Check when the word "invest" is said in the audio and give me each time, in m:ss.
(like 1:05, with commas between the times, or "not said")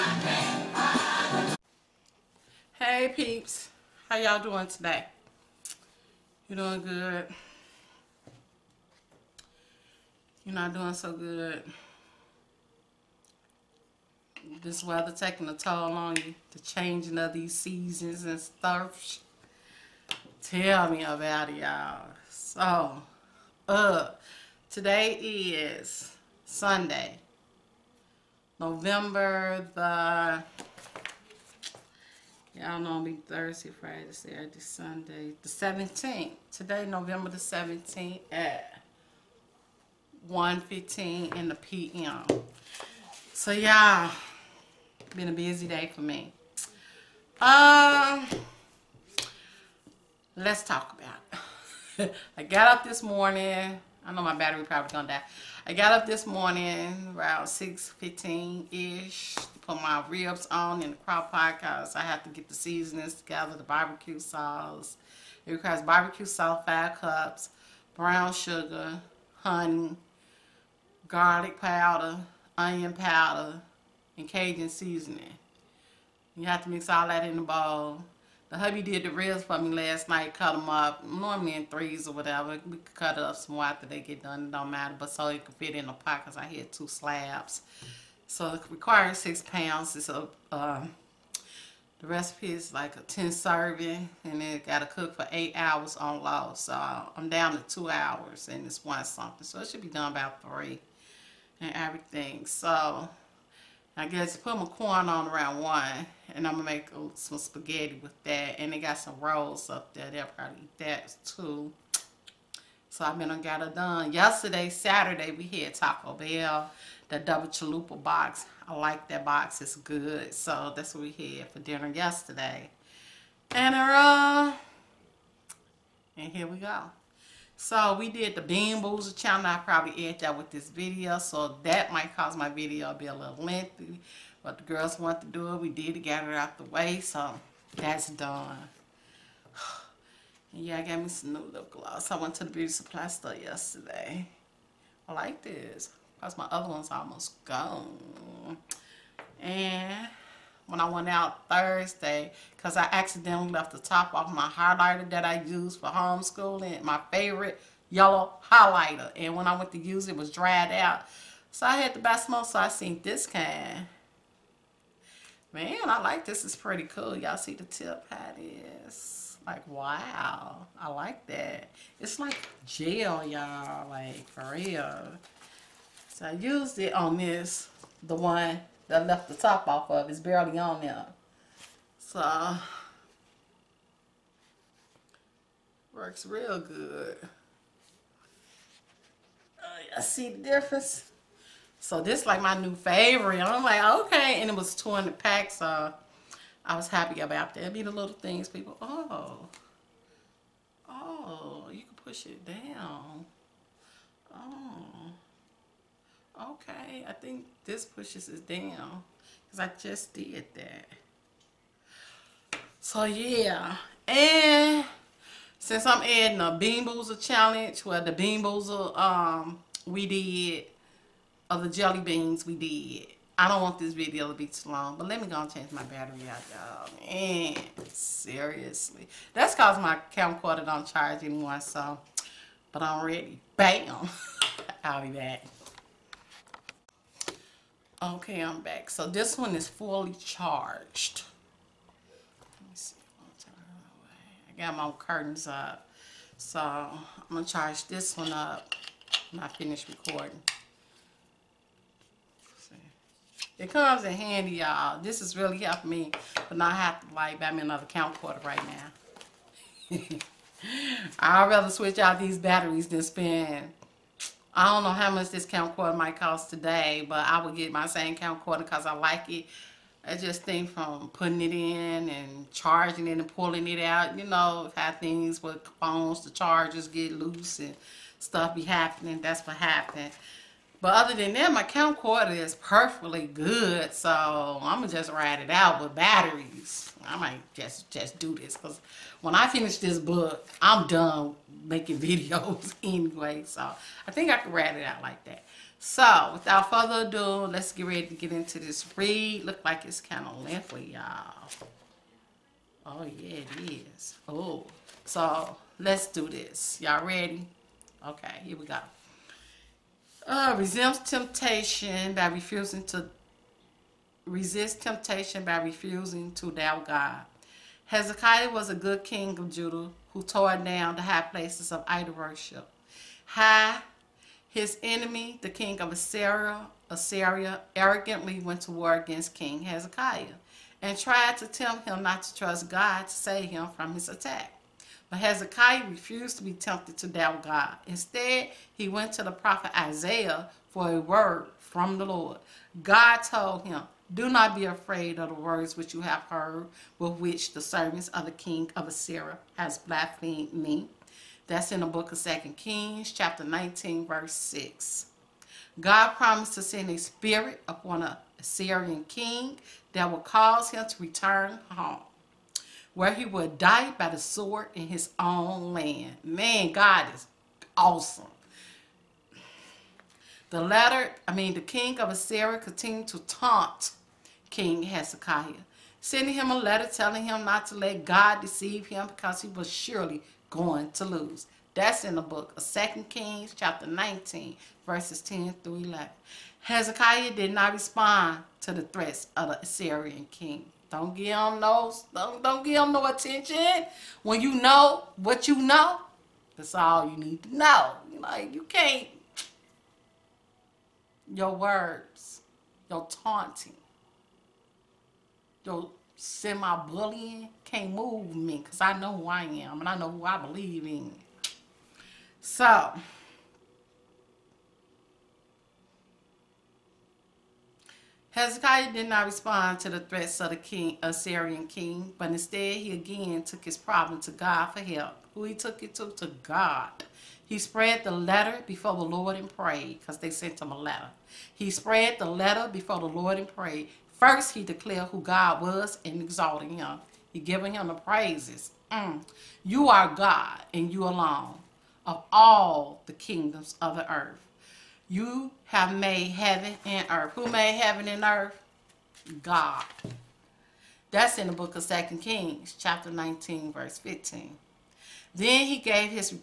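not said.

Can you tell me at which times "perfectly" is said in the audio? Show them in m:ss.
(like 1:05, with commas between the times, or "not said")
4:42.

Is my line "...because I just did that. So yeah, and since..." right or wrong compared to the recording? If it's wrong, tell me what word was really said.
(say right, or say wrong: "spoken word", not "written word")
right.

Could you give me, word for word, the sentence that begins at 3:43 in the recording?
I don't want this video to be too long, but let me go and change my battery out, y'all.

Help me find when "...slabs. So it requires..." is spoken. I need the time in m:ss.
1:26.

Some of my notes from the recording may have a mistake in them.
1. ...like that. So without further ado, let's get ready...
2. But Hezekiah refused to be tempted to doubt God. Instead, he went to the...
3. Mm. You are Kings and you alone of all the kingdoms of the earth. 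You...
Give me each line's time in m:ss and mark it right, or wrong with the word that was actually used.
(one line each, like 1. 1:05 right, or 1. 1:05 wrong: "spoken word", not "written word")
1. 4:55 right
2. 5:35 right
3. 7:18 wrong: "God", not "Kings".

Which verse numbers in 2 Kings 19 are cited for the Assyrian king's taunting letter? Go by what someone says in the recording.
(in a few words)
10 through 11.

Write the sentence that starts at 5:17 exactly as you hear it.
Hezekiah was a good king of Judah who tore down the high places of idol worship.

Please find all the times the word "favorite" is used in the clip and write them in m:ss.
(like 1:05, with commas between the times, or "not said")
2:37, 3:12.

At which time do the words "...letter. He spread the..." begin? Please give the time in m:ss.
7:10.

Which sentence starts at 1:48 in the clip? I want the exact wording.
And they got some rolls up there.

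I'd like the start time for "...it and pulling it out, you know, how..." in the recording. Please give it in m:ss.
4:33.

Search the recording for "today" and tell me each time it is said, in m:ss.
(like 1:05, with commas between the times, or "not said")
0:04, 0:24, 0:36, 4:26.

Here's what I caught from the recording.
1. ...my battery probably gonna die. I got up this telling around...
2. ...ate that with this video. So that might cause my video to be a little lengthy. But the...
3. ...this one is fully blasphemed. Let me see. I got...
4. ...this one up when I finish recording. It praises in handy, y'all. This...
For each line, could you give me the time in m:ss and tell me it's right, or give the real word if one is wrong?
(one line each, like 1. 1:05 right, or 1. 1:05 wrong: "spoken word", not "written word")
1. 0:54 wrong: "morning", not "telling"
2. 2:10 right
3. 3:59 wrong: "charged", not "blasphemed"
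4. 4:07 wrong: "comes", not "praises".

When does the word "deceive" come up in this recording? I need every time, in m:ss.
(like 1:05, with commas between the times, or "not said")
6:18.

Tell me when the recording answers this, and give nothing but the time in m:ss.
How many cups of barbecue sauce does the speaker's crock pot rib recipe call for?
1:06.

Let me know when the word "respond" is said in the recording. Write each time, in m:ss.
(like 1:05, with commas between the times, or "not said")
6:27, 6:59.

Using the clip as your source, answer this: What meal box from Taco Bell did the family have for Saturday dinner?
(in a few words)
double chalupa box.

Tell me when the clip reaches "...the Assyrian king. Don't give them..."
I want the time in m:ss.
6:29.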